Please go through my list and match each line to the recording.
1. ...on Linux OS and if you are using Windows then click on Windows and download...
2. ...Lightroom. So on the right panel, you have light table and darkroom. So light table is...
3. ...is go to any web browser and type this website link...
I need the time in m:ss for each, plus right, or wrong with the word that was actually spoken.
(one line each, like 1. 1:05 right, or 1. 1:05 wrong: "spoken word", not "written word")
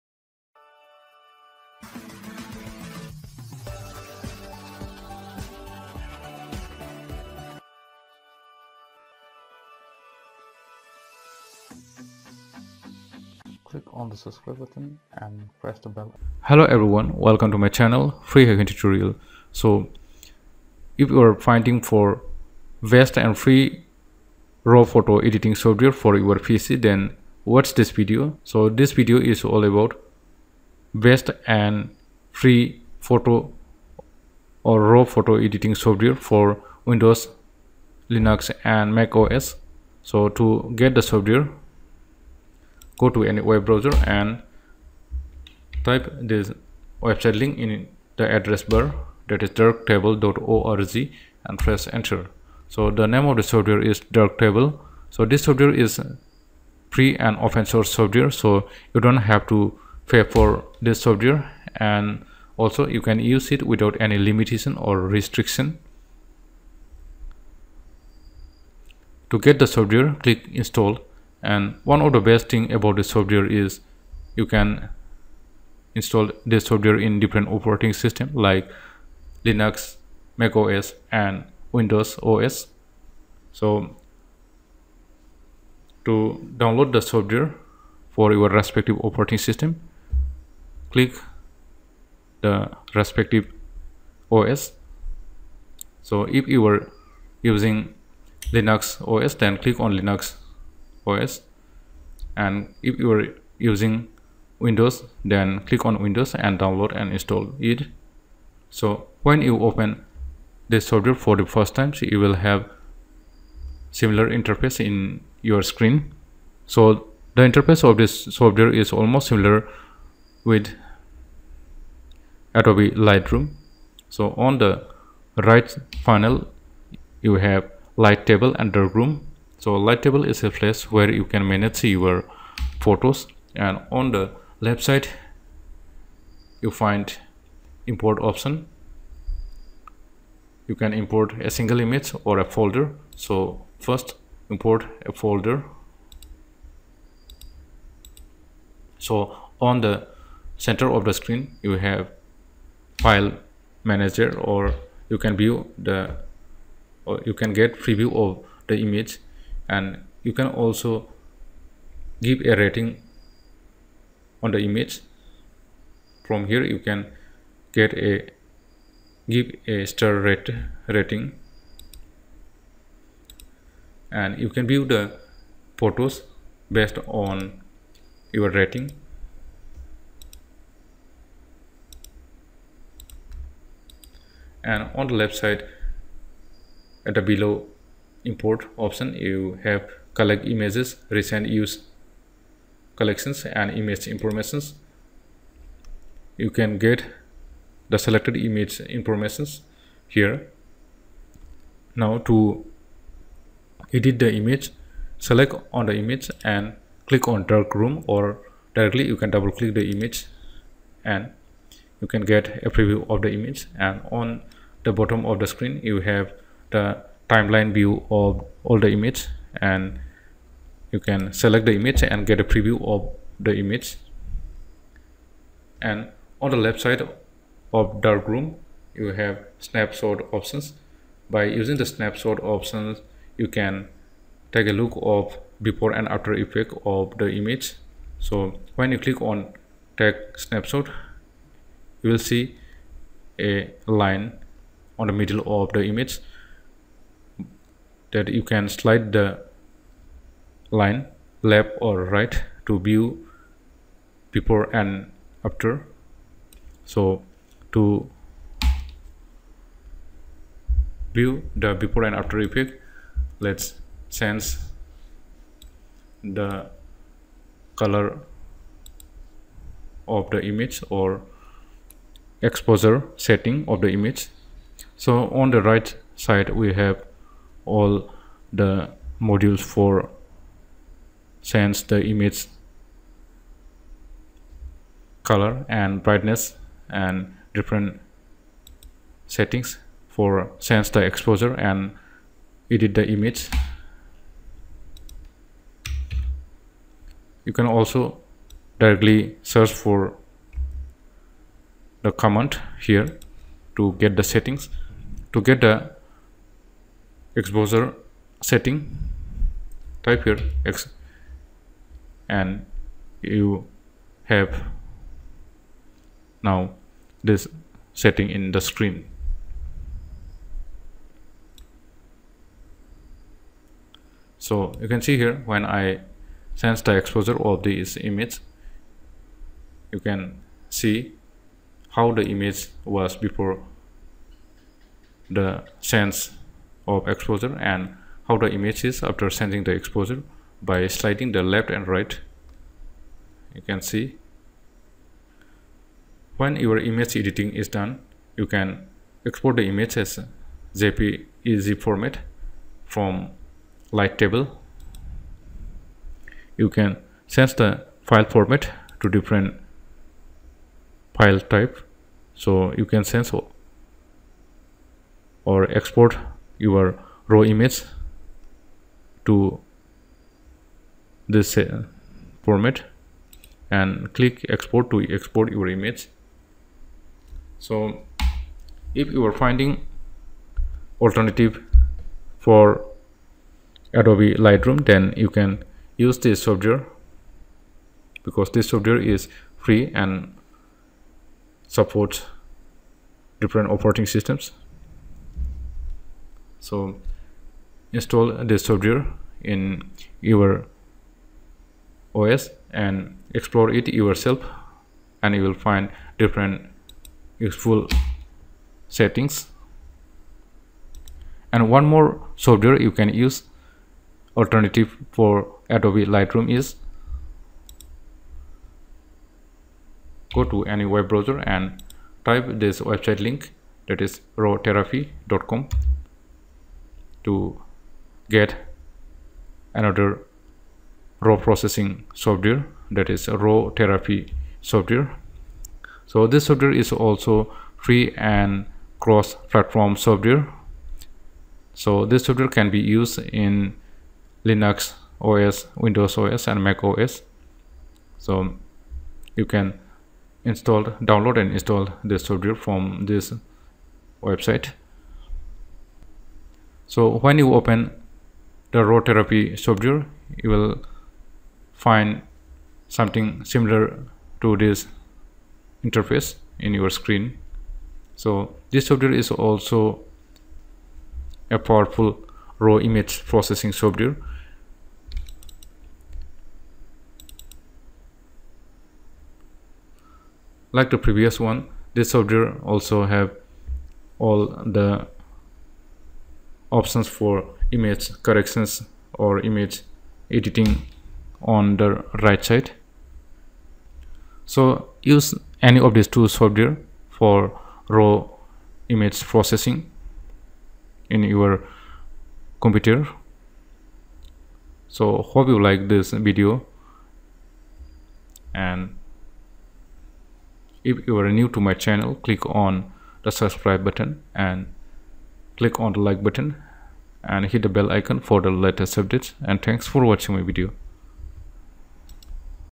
1. 1:39 right
2. 2:02 right
3. 6:56 right.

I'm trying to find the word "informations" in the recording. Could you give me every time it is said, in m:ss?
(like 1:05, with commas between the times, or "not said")
3:14, 3:18.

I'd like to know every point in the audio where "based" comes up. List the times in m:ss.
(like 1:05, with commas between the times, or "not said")
2:56.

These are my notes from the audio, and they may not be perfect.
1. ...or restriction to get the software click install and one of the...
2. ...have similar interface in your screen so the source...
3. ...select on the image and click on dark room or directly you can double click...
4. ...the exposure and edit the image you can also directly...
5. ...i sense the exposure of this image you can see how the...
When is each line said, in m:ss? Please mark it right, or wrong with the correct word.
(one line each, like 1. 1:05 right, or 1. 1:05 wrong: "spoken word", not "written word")
1. 1:04 right
2. 1:52 wrong: "interface", not "source"
3. 3:25 right
4. 4:50 right
5. 5:25 right.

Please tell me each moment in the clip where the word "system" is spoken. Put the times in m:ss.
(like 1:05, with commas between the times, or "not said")
1:17, 1:29, 6:34.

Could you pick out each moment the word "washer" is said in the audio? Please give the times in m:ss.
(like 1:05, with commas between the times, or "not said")
not said.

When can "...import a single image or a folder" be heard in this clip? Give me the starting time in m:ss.
2:20.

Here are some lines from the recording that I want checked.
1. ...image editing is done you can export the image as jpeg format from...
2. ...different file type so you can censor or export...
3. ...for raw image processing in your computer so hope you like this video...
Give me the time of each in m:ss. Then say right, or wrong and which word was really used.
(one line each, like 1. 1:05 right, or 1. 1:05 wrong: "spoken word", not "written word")
1. 5:46 right
2. 5:59 right
3. 8:17 right.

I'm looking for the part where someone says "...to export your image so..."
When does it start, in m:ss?
6:14.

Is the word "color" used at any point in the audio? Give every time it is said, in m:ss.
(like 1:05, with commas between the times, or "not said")
4:27, 4:45.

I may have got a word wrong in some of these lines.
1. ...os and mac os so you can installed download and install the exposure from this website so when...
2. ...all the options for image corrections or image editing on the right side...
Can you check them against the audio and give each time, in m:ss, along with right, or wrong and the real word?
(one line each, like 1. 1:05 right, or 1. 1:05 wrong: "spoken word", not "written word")
1. 7:26 wrong: "software", not "exposure"
2. 8:04 right.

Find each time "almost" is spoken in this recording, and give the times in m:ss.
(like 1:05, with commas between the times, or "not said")
1:58.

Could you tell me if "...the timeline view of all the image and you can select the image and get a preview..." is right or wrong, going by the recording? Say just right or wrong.
right.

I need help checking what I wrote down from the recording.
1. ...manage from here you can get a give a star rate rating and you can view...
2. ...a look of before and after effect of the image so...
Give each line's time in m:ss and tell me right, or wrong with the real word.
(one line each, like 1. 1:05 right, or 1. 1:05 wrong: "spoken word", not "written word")
1. 2:44 wrong: "image", not "manage"
2. 3:54 right.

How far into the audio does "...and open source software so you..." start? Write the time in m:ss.
0:57.